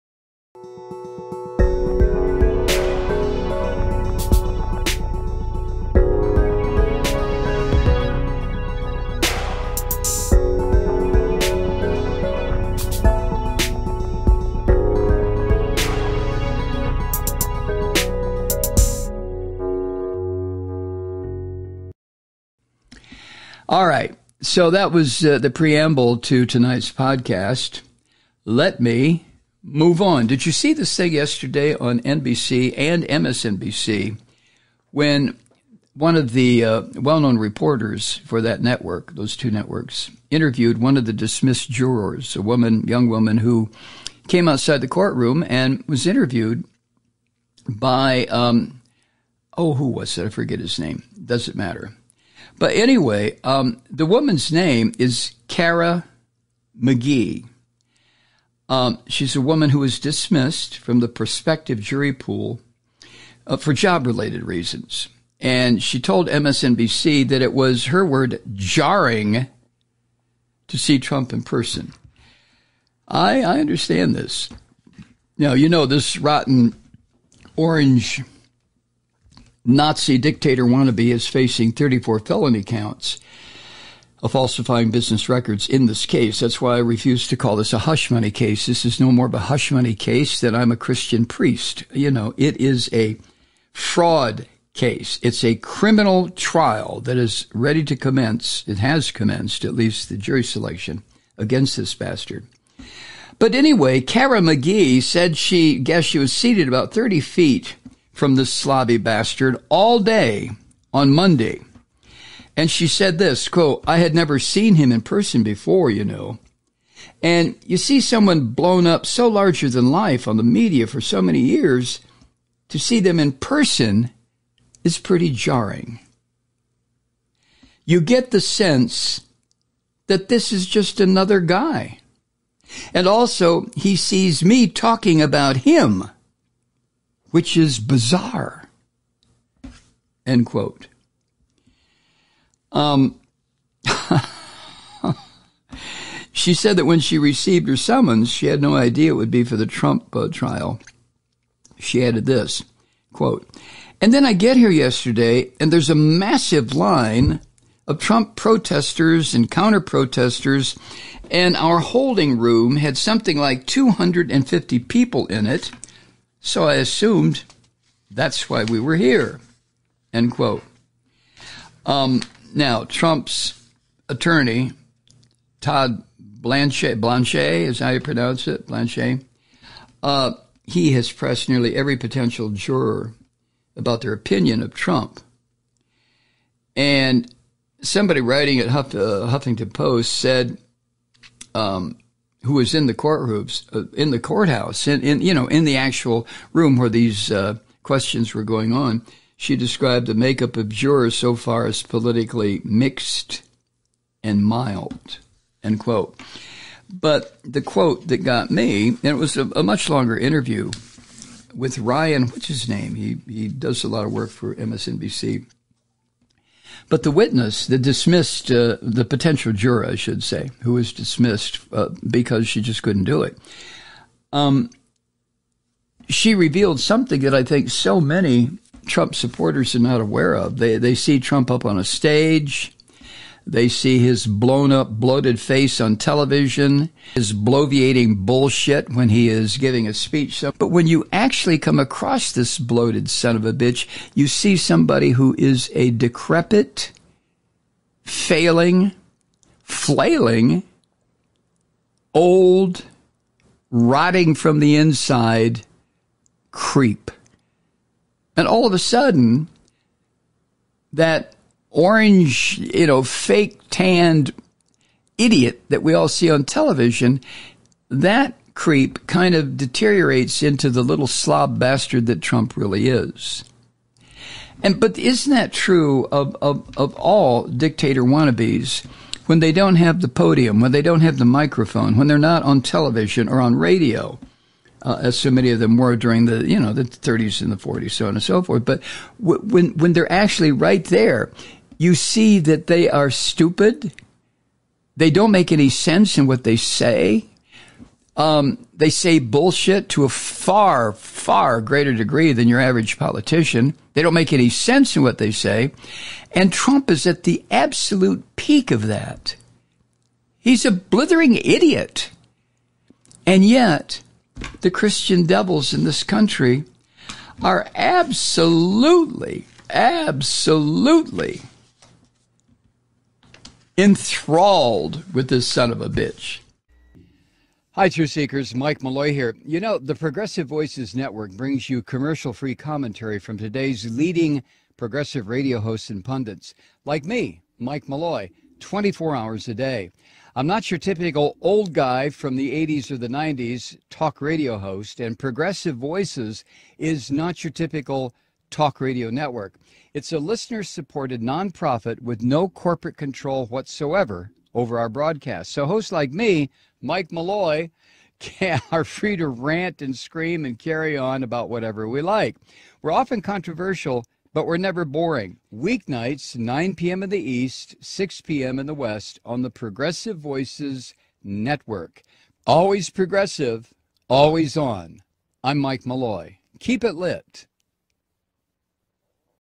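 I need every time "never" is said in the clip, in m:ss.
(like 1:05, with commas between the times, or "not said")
1:54, 6:04.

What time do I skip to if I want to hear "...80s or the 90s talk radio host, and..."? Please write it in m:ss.
5:42.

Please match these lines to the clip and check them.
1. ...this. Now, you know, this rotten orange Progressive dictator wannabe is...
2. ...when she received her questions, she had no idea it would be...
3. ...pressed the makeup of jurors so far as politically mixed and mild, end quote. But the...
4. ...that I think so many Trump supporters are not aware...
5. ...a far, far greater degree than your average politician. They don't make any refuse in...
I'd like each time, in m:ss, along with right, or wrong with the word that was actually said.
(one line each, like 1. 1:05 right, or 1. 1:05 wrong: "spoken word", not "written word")
1. 1:14 wrong: "Nazi", not "Progressive"
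2. 2:26 wrong: "summons", not "questions"
3. 3:19 wrong: "described", not "pressed"
4. 3:47 right
5. 5:00 wrong: "sense", not "refuse".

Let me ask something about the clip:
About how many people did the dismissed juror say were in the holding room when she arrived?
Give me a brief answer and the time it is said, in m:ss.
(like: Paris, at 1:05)
250, at 2:43.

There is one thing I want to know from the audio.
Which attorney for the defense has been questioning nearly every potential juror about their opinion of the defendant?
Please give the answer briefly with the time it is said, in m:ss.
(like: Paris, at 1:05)
Todd Blanchet, at 2:55.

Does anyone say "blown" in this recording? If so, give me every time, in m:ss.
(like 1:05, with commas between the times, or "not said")
1:58, 3:54.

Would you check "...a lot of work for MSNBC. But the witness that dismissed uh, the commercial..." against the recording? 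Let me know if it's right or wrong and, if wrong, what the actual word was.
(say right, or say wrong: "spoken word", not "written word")
wrong: "potential", not "commercial".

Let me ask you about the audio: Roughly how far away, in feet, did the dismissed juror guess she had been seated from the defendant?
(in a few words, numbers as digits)
30 feet.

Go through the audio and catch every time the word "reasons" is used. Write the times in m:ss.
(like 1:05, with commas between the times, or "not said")
1:04.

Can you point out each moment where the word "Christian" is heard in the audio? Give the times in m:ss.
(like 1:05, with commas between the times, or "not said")
1:30, 5:14.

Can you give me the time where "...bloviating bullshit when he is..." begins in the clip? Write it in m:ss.
3:57.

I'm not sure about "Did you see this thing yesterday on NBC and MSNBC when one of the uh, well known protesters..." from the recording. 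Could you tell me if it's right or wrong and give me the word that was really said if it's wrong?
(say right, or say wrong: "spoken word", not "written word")
wrong: "reporters", not "protesters".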